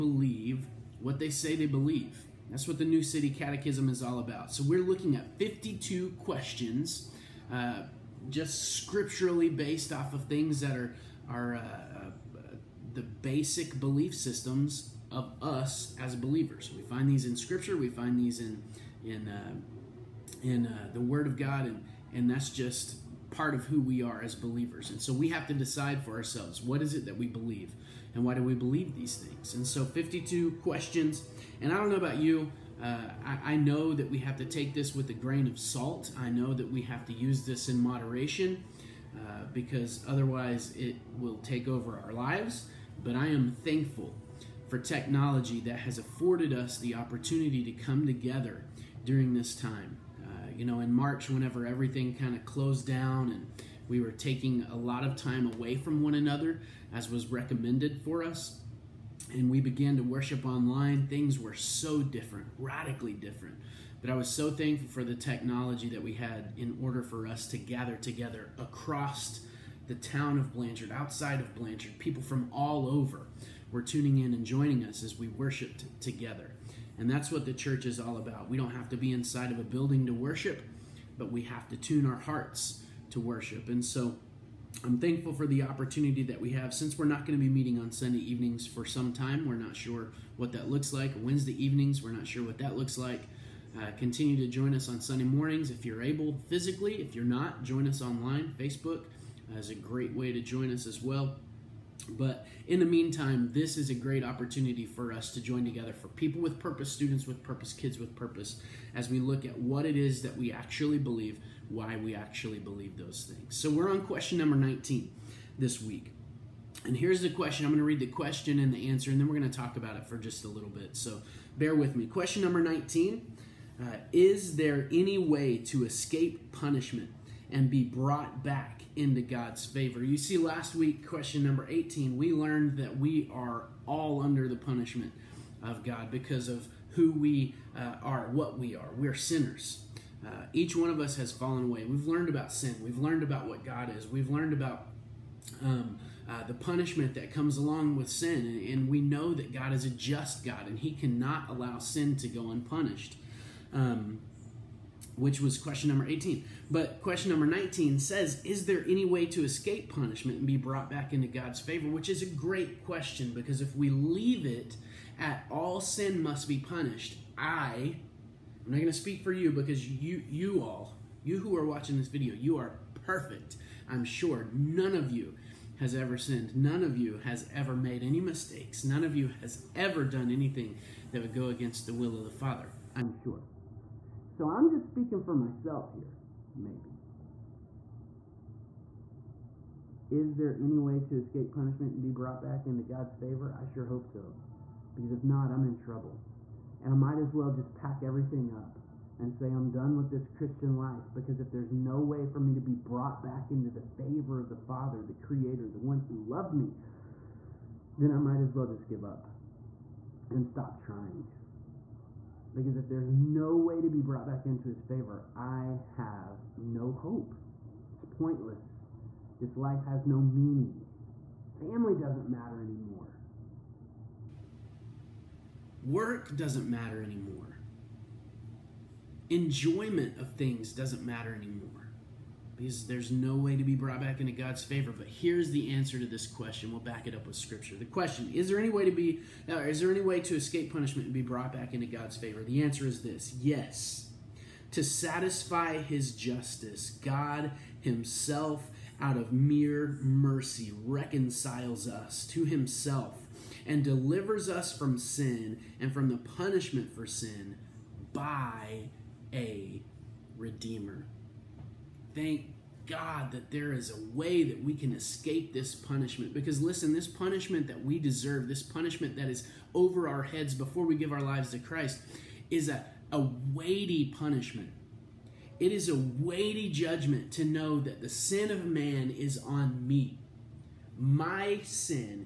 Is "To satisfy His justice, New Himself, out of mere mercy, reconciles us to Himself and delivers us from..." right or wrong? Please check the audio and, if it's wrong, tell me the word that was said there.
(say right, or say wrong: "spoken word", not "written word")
wrong: "God", not "New".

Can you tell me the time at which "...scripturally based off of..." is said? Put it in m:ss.
0:08.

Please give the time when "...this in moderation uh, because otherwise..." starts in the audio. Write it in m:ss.
0:37.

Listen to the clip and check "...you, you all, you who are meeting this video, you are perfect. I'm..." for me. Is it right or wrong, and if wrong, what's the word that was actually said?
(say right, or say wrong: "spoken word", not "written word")
wrong: "watching", not "meeting".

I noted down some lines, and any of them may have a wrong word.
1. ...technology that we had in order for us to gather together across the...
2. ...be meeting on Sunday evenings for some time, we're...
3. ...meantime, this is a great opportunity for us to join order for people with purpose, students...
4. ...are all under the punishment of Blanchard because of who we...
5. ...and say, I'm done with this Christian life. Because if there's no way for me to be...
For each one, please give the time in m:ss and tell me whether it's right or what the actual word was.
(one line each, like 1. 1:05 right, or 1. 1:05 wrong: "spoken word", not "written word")
1. 1:05 right
2. 1:27 right
3. 1:42 wrong: "together", not "order"
4. 2:13 wrong: "God", not "Blanchard"
5. 3:19 right.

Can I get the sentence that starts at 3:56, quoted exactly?
We'll back it up with Scripture.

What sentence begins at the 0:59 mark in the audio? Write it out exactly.
And we began to worship online.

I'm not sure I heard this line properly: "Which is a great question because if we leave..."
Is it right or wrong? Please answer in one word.
right.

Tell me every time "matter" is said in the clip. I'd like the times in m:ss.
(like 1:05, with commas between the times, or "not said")
3:42, 3:46, 3:51.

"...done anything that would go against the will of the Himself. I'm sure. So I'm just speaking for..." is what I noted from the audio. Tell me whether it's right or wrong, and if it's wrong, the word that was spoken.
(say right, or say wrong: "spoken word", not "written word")
wrong: "Father", not "Himself".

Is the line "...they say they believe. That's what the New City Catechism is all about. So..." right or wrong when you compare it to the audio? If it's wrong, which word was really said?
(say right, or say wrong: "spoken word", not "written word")
right.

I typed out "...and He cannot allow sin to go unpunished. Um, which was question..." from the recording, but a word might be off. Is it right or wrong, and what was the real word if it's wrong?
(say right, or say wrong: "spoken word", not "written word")
right.